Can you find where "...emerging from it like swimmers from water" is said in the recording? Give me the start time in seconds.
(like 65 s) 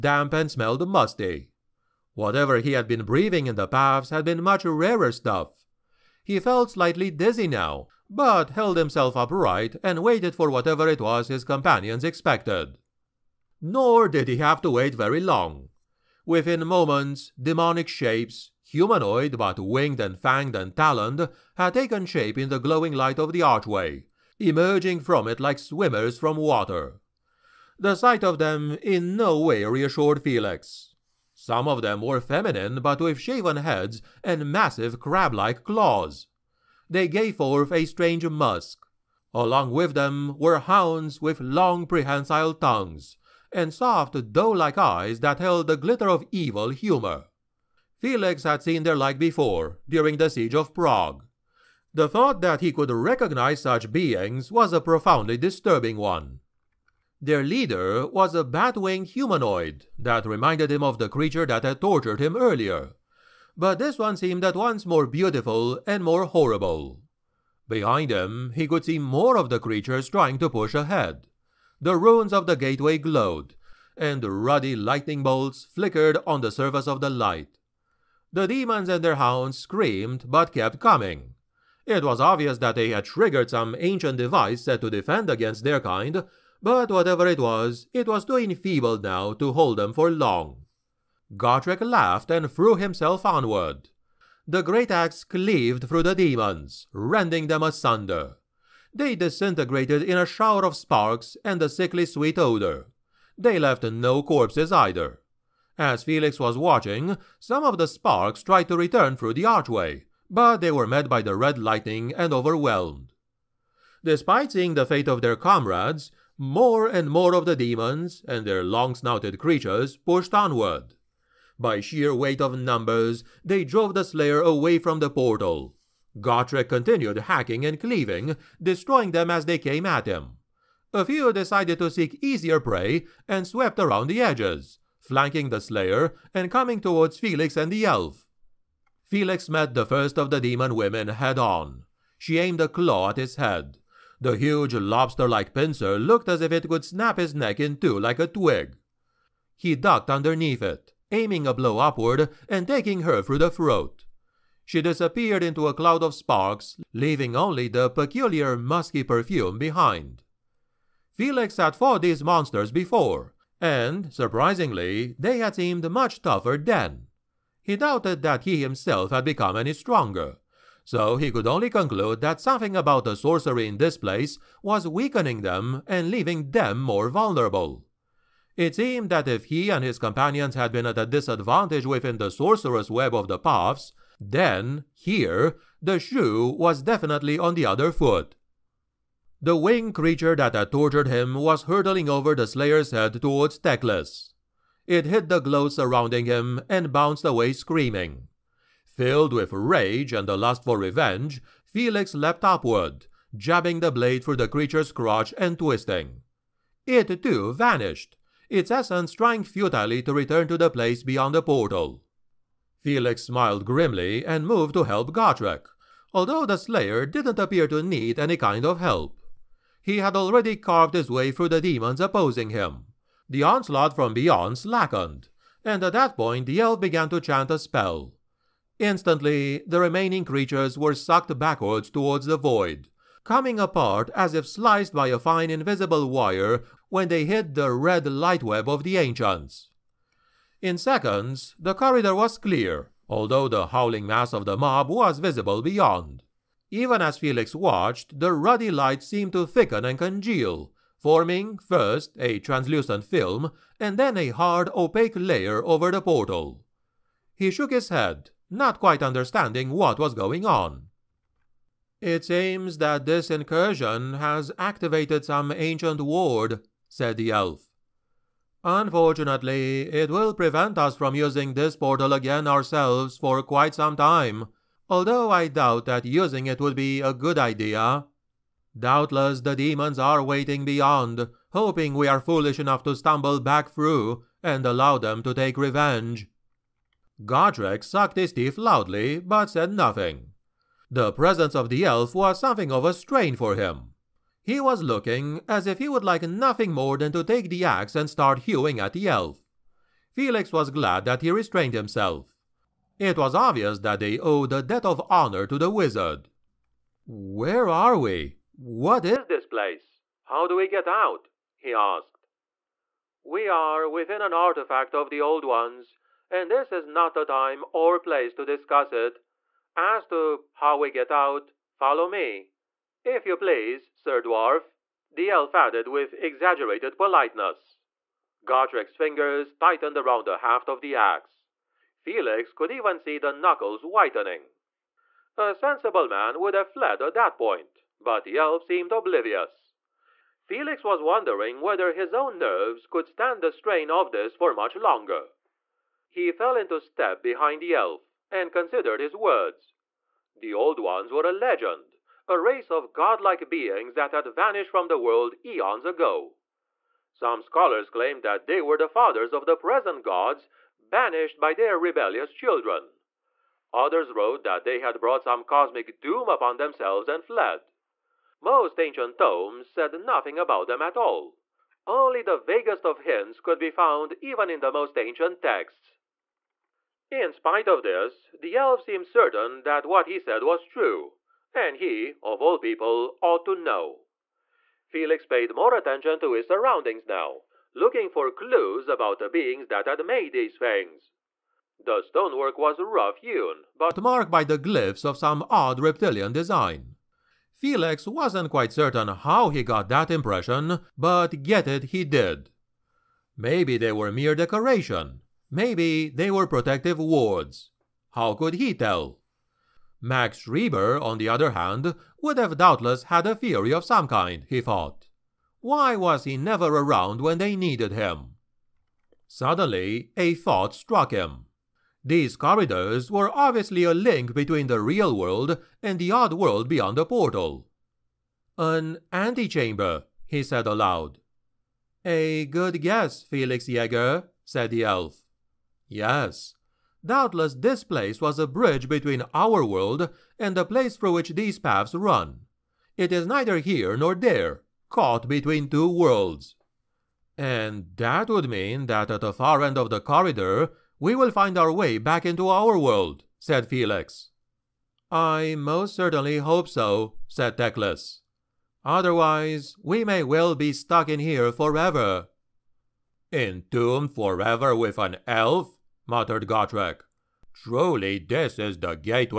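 24 s.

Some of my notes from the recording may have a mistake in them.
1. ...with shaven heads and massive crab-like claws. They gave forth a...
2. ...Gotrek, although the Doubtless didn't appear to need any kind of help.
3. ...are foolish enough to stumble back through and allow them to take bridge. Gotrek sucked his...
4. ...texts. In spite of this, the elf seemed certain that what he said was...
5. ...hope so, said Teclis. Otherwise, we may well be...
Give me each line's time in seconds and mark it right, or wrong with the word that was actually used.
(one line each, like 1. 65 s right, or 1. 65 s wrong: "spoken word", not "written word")
1. 32 s right
2. 215 s wrong: "Slayer", not "Doubtless"
3. 282 s wrong: "revenge", not "bridge"
4. 375 s right
5. 456 s right.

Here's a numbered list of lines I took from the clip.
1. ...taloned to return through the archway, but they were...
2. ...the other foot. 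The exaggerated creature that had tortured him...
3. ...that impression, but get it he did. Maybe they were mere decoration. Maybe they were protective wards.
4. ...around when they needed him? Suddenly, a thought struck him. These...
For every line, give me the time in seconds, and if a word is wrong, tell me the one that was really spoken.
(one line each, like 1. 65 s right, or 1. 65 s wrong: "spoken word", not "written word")
1. 108 s wrong: "tried", not "taloned"
2. 187 s wrong: "winged", not "exaggerated"
3. 399 s right
4. 416 s right.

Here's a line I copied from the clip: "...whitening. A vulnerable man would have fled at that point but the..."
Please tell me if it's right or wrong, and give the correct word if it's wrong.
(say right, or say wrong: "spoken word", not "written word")
wrong: "sensible", not "vulnerable".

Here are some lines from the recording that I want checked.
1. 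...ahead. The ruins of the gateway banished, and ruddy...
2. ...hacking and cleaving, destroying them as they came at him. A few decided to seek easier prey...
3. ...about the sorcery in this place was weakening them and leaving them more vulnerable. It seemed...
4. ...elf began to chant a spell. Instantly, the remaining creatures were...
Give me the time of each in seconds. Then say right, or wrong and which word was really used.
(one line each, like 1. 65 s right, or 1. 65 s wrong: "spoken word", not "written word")
1. 70 s wrong: "glowed", not "banished"
2. 127 s right
3. 172 s right
4. 226 s right.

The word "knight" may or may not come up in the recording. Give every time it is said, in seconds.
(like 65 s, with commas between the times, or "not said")
not said.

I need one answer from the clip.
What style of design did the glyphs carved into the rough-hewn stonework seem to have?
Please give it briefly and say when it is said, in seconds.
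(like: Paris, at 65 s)
Reptilian, at 395 s.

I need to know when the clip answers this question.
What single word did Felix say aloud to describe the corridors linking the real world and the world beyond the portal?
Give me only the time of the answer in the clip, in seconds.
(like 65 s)
428 s.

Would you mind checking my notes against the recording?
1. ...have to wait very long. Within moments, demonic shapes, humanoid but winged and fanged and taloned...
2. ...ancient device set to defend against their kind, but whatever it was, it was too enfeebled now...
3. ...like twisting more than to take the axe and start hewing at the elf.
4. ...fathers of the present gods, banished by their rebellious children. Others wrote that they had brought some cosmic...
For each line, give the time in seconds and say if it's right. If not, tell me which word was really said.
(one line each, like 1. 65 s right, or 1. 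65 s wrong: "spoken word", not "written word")
1. 14 s right
2. 83 s right
3. 296 s wrong: "nothing", not "twisting"
4. 358 s right.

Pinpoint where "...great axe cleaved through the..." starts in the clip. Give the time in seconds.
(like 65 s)
94 s.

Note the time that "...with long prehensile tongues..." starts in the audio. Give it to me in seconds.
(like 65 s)
41 s.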